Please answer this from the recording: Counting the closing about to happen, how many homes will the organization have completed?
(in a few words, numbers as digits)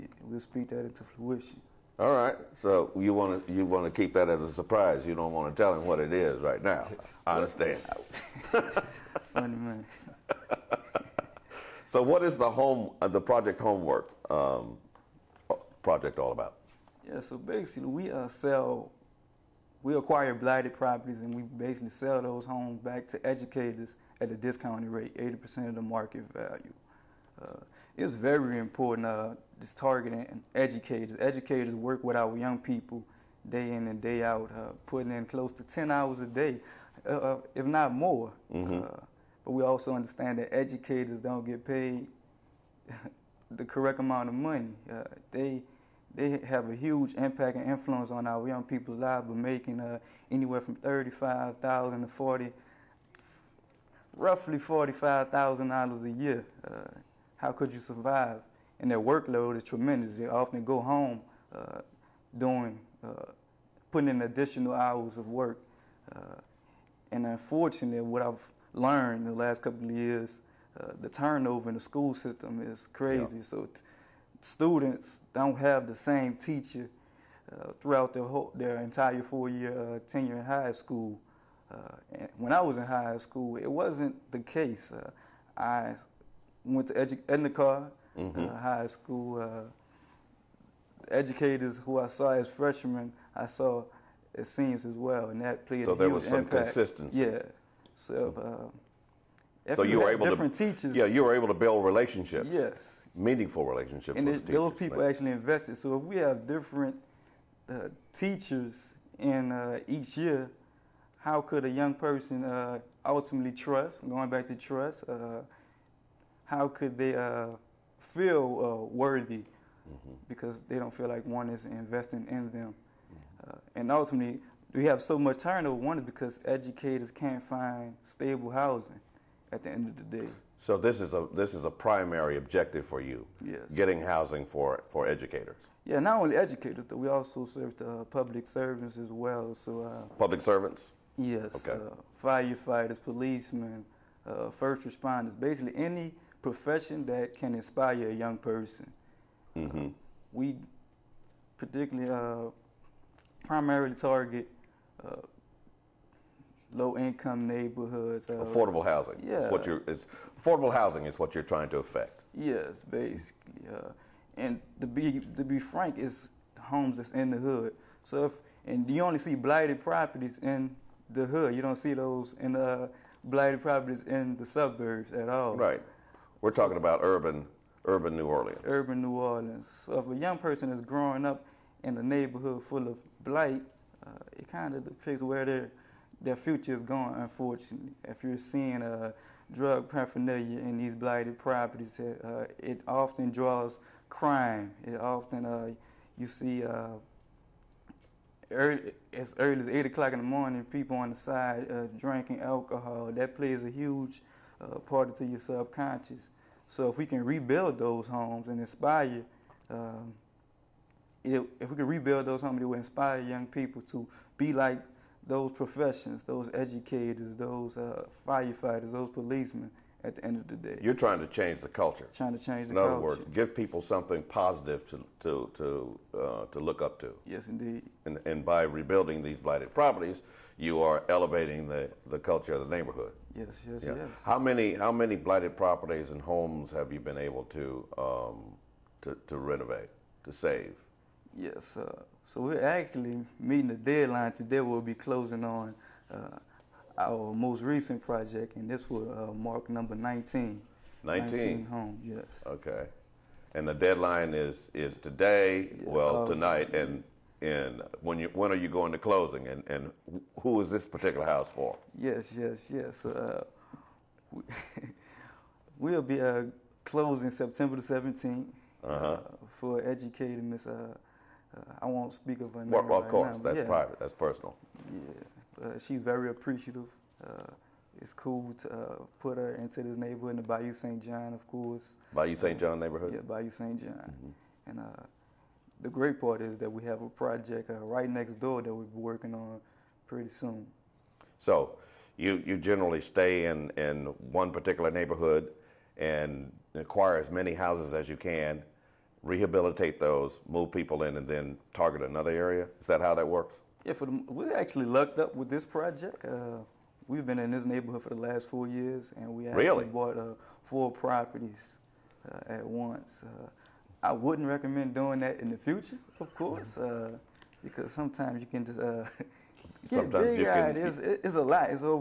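19.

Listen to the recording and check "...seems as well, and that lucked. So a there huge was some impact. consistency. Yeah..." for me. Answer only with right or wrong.
wrong.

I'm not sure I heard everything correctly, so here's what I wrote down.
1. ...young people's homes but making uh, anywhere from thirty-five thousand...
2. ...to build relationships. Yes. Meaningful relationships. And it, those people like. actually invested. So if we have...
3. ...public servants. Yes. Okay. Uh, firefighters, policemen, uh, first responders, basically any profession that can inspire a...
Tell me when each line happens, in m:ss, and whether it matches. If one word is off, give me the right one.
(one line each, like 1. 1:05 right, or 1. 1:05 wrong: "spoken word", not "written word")
1. 0:48 wrong: "lives", not "homes"
2. 1:41 right
3. 2:20 right.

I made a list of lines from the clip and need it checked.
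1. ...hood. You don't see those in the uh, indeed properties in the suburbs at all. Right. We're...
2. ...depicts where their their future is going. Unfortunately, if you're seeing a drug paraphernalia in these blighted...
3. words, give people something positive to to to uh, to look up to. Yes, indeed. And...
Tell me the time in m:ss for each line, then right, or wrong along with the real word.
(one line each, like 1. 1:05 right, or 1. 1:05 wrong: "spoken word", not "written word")
1. 2:51 wrong: "blighted", not "indeed"
2. 3:04 right
3. 3:43 right.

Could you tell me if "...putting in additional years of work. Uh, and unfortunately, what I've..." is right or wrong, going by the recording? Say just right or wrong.
wrong.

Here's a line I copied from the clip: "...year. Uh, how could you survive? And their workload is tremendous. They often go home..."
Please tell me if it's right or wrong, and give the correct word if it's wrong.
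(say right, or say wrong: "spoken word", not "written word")
right.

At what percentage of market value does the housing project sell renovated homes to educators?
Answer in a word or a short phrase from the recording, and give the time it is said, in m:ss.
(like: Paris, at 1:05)
80%, at 0:25.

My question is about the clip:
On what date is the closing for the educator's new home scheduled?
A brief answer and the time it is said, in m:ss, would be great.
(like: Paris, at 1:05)
September 17, at 4:27.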